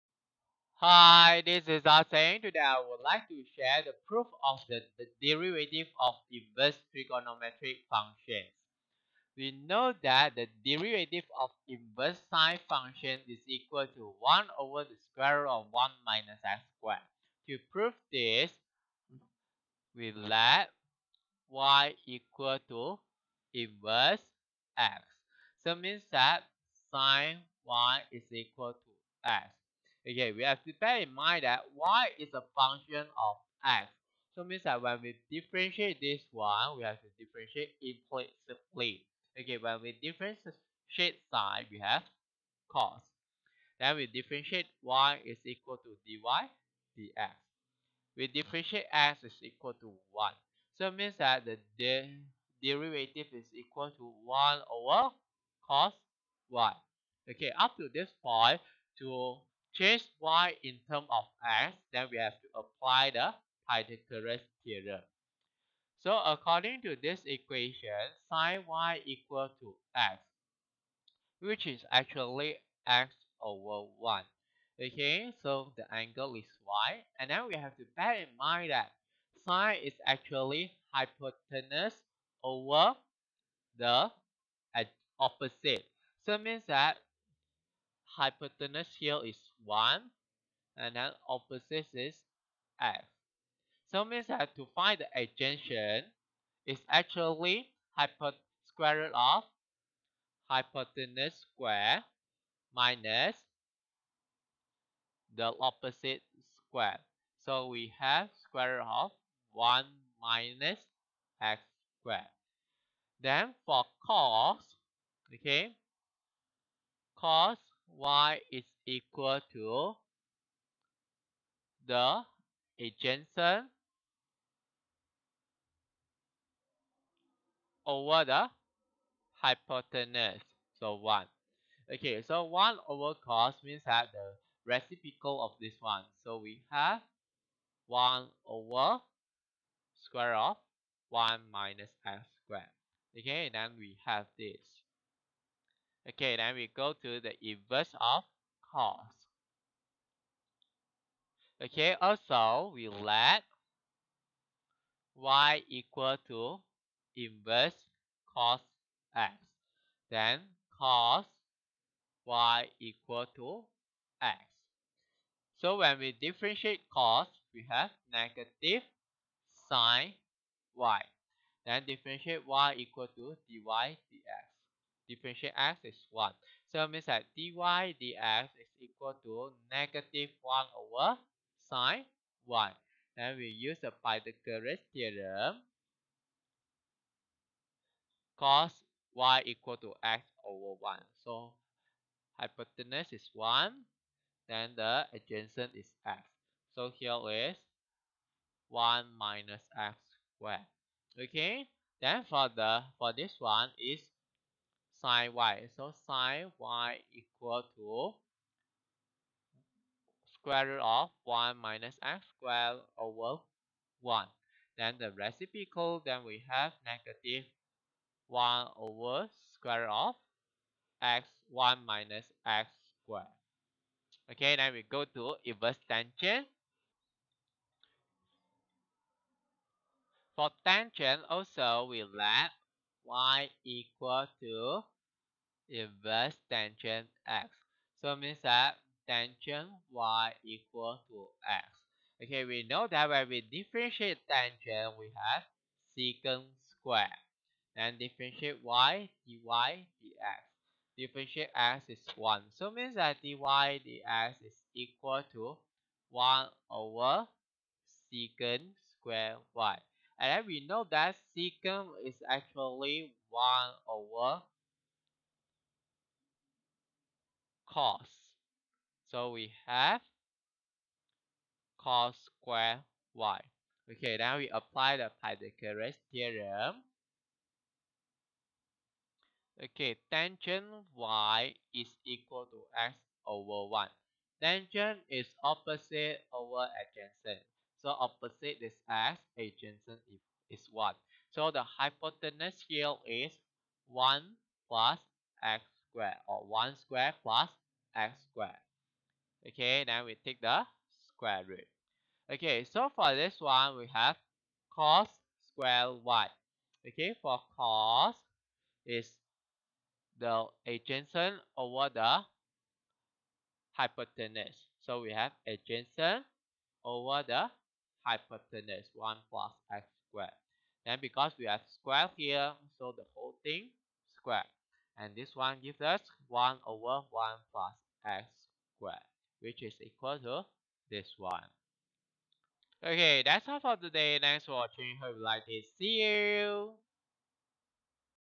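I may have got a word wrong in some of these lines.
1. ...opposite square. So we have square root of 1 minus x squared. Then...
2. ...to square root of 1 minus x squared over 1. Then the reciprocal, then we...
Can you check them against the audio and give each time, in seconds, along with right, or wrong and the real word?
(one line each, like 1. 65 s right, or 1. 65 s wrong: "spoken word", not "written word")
1. 105 s right
2. 207 s right.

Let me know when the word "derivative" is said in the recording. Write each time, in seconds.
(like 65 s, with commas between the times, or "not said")
5 s, 10 s, 52 s.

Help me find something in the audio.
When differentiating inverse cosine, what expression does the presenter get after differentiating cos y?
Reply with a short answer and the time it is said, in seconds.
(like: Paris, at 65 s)
negative sine y, at 168 s.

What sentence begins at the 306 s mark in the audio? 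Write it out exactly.
Okay, for cos is the adjacent over the hypotenuse.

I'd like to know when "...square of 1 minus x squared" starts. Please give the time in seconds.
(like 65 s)
140 s.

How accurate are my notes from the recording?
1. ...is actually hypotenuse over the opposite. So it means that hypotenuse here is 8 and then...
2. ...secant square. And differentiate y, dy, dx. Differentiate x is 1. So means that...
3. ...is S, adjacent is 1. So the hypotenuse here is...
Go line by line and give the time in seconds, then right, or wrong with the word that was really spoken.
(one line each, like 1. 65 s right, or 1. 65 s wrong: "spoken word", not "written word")
1. 79 s wrong: "1", not "8"
2. 245 s right
3. 288 s right.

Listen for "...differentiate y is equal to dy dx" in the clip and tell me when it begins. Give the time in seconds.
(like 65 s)
44 s.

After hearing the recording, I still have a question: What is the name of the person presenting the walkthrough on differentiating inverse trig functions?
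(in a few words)
Arsene.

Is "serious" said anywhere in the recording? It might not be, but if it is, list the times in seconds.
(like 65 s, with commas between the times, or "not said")
not said.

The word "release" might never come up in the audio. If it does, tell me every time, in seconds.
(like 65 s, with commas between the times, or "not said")
not said.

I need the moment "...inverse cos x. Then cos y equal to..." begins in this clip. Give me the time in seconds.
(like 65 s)
157 s.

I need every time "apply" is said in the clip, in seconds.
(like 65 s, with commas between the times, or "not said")
62 s, 274 s.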